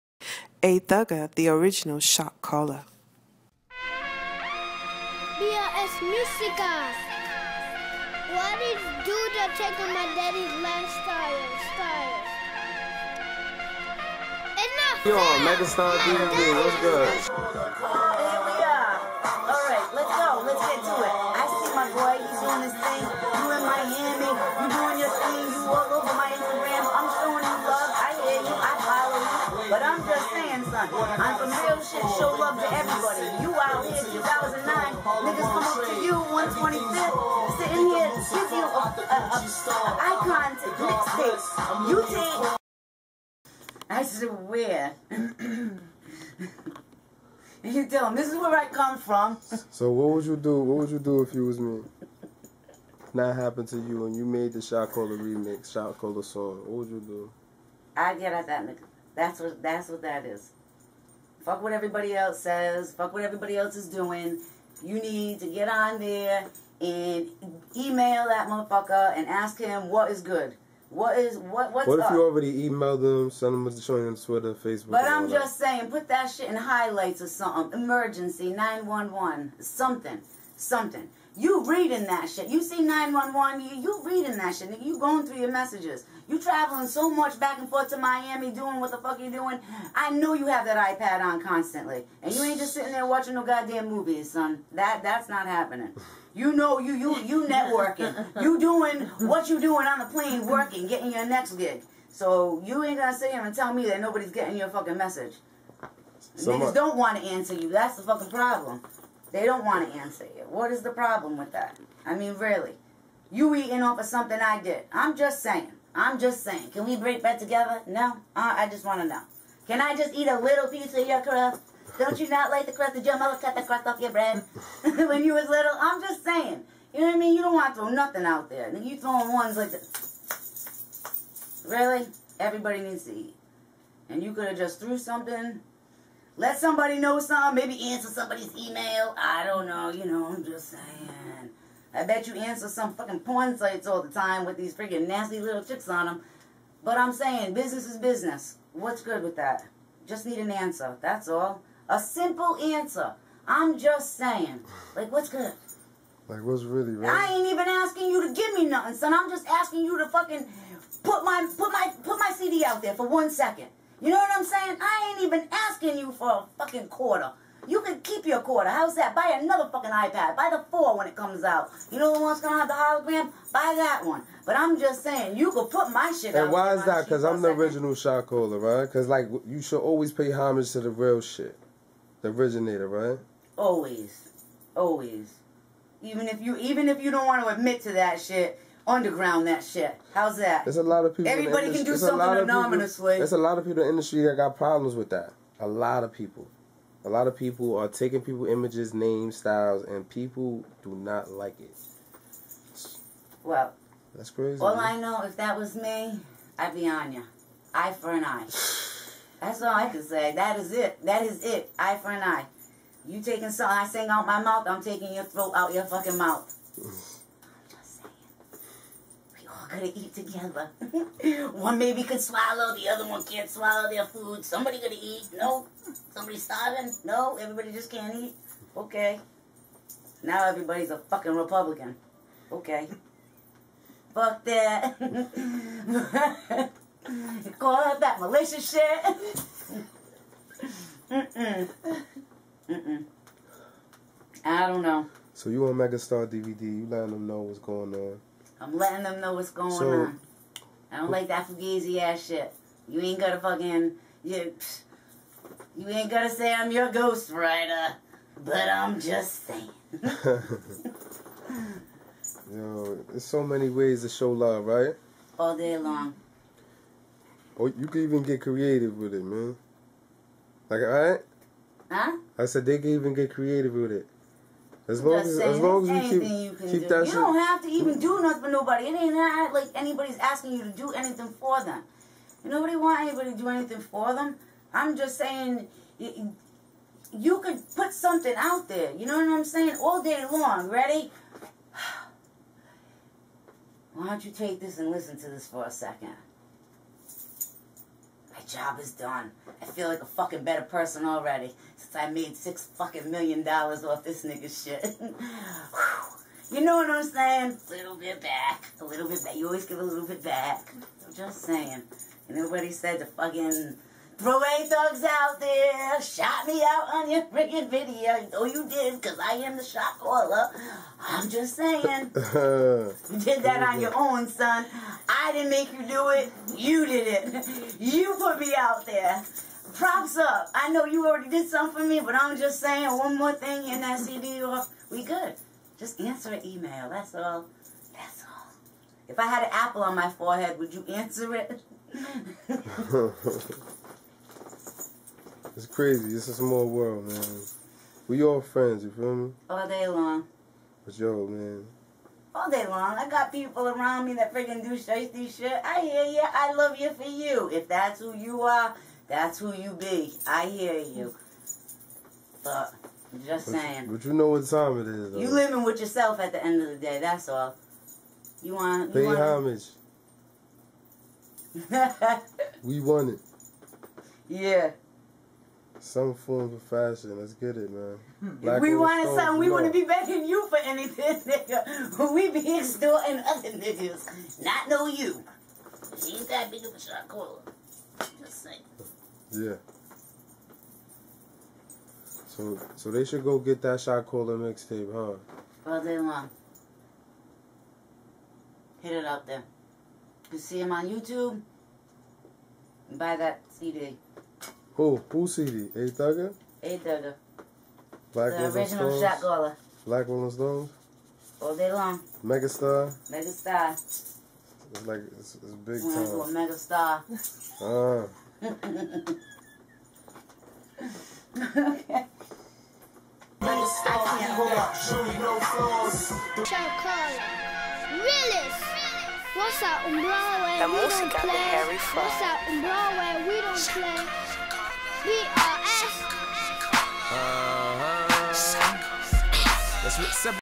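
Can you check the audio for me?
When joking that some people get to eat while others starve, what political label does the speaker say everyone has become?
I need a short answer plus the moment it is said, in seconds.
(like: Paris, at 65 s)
Republican, at 231 s.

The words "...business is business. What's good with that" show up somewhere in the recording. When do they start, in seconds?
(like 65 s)
147 s.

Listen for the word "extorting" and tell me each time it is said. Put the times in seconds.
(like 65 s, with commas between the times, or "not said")
382 s.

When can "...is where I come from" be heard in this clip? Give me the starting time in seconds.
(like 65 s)
48 s.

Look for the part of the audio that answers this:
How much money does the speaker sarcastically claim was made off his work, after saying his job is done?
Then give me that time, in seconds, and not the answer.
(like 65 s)
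302 s.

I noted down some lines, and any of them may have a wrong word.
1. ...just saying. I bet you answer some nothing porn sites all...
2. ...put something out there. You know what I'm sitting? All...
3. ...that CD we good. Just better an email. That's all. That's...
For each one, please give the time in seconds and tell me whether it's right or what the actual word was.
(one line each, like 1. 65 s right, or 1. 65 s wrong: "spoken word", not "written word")
1. 140 s wrong: "fucking", not "nothing"
2. 287 s wrong: "saying", not "sitting"
3. 333 s wrong: "answer", not "better".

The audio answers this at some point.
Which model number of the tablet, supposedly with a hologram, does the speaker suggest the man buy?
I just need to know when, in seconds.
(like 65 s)
170 s.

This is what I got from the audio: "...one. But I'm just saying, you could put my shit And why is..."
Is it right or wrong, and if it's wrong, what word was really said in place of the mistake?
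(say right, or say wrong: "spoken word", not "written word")
right.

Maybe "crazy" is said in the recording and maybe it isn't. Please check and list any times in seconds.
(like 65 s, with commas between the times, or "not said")
204 s, 345 s.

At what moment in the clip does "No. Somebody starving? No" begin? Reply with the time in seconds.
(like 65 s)
225 s.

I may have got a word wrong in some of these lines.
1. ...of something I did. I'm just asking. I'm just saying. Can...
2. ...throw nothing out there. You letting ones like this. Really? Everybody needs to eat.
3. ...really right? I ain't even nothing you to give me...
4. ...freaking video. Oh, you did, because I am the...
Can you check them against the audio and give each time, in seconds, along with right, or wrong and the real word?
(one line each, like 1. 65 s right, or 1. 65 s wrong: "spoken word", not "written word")
1. 113 s wrong: "saying", not "asking"
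2. 127 s wrong: "throwing", not "letting"
3. 156 s wrong: "asking", not "nothing"
4. 317 s right.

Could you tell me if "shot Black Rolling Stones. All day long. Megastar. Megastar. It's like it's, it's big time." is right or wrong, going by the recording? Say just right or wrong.
right.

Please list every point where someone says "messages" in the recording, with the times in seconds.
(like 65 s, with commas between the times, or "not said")
85 s, 104 s.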